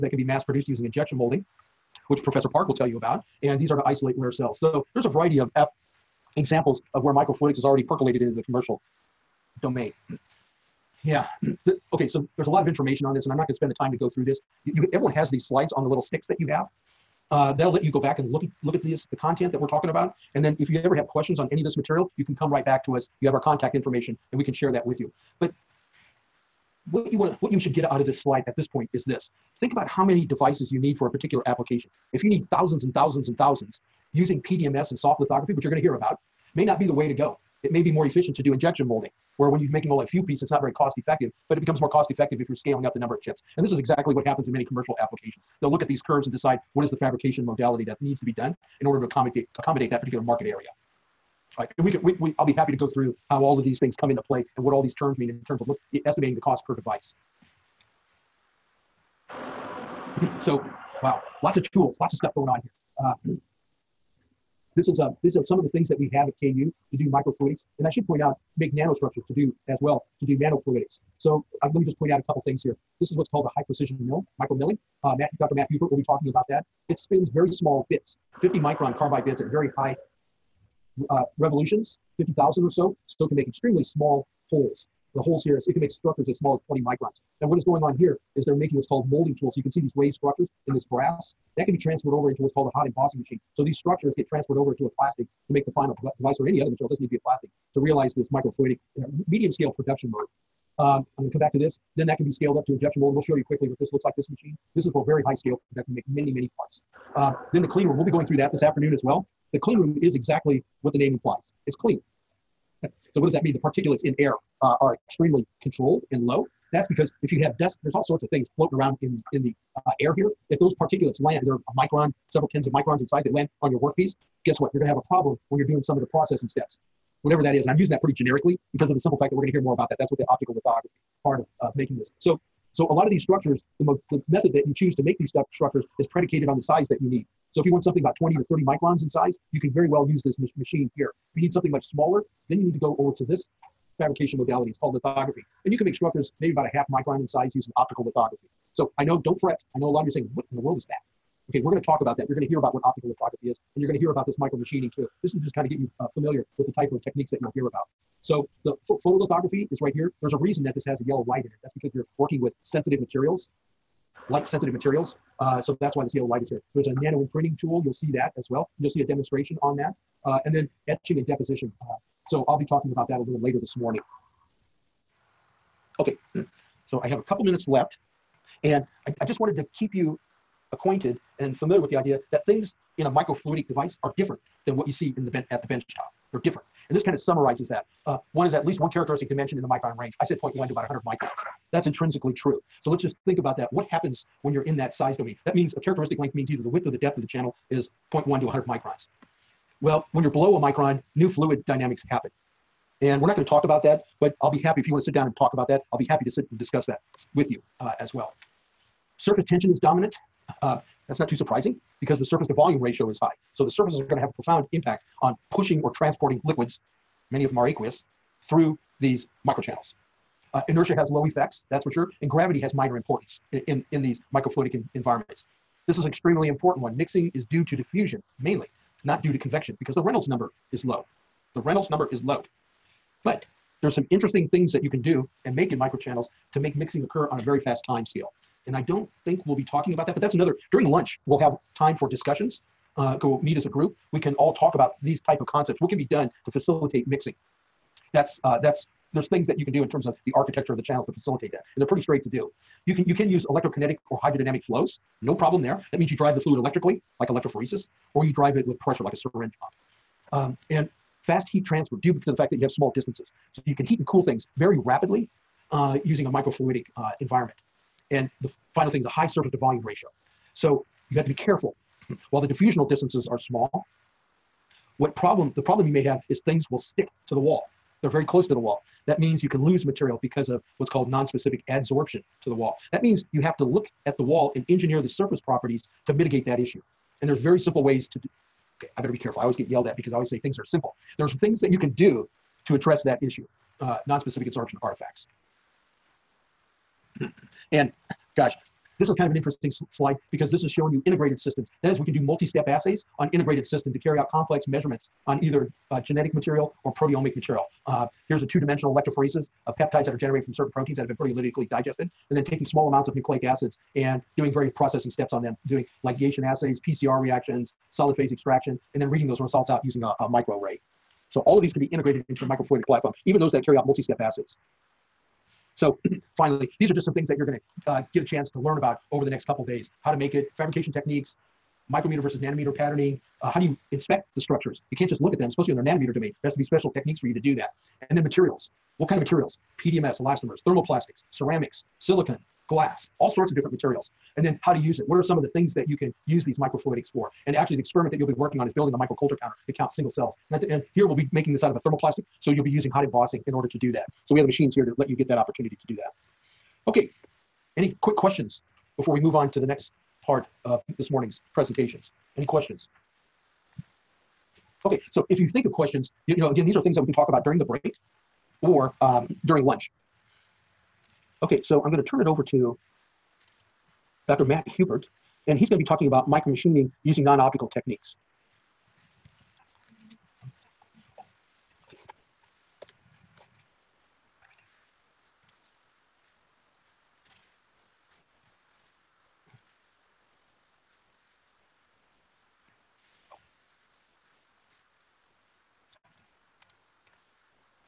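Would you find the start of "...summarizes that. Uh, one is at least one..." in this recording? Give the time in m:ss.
3:07.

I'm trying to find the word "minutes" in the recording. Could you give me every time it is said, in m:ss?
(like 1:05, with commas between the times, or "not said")
2:57.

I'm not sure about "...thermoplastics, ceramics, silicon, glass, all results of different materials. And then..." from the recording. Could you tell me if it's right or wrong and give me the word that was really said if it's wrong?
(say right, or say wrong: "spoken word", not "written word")
wrong: "sorts", not "results".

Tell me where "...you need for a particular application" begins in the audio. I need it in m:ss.
0:30.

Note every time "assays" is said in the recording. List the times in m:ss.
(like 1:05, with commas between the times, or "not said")
5:02, 5:16, 5:24.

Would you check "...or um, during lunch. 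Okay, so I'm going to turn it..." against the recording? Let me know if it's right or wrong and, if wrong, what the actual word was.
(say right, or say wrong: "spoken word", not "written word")
right.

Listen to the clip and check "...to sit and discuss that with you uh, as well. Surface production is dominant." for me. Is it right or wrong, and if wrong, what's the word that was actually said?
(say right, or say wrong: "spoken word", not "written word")
wrong: "tension", not "production".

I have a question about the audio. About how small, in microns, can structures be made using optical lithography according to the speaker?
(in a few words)
half micron.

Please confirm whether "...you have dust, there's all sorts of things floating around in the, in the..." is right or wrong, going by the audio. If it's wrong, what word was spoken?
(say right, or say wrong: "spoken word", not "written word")
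right.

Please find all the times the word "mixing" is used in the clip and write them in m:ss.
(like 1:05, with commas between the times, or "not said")
3:46, 3:56, 4:07.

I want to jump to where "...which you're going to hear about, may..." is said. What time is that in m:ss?
0:35.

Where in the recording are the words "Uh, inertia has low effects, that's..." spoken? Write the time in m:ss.
3:40.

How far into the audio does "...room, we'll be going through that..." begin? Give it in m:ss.
1:47.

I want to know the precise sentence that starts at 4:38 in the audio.
They're very close to the wall.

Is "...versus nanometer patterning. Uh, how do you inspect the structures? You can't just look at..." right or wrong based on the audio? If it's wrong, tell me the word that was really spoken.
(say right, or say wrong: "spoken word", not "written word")
right.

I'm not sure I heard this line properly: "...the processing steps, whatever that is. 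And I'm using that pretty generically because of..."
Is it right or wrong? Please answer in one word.
right.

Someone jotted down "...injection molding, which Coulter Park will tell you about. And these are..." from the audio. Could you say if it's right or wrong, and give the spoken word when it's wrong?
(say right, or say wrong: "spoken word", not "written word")
wrong: "Professor", not "Coulter".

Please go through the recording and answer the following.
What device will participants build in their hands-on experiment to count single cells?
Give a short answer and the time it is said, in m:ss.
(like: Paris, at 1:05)
micro Coulter counter, at 5:48.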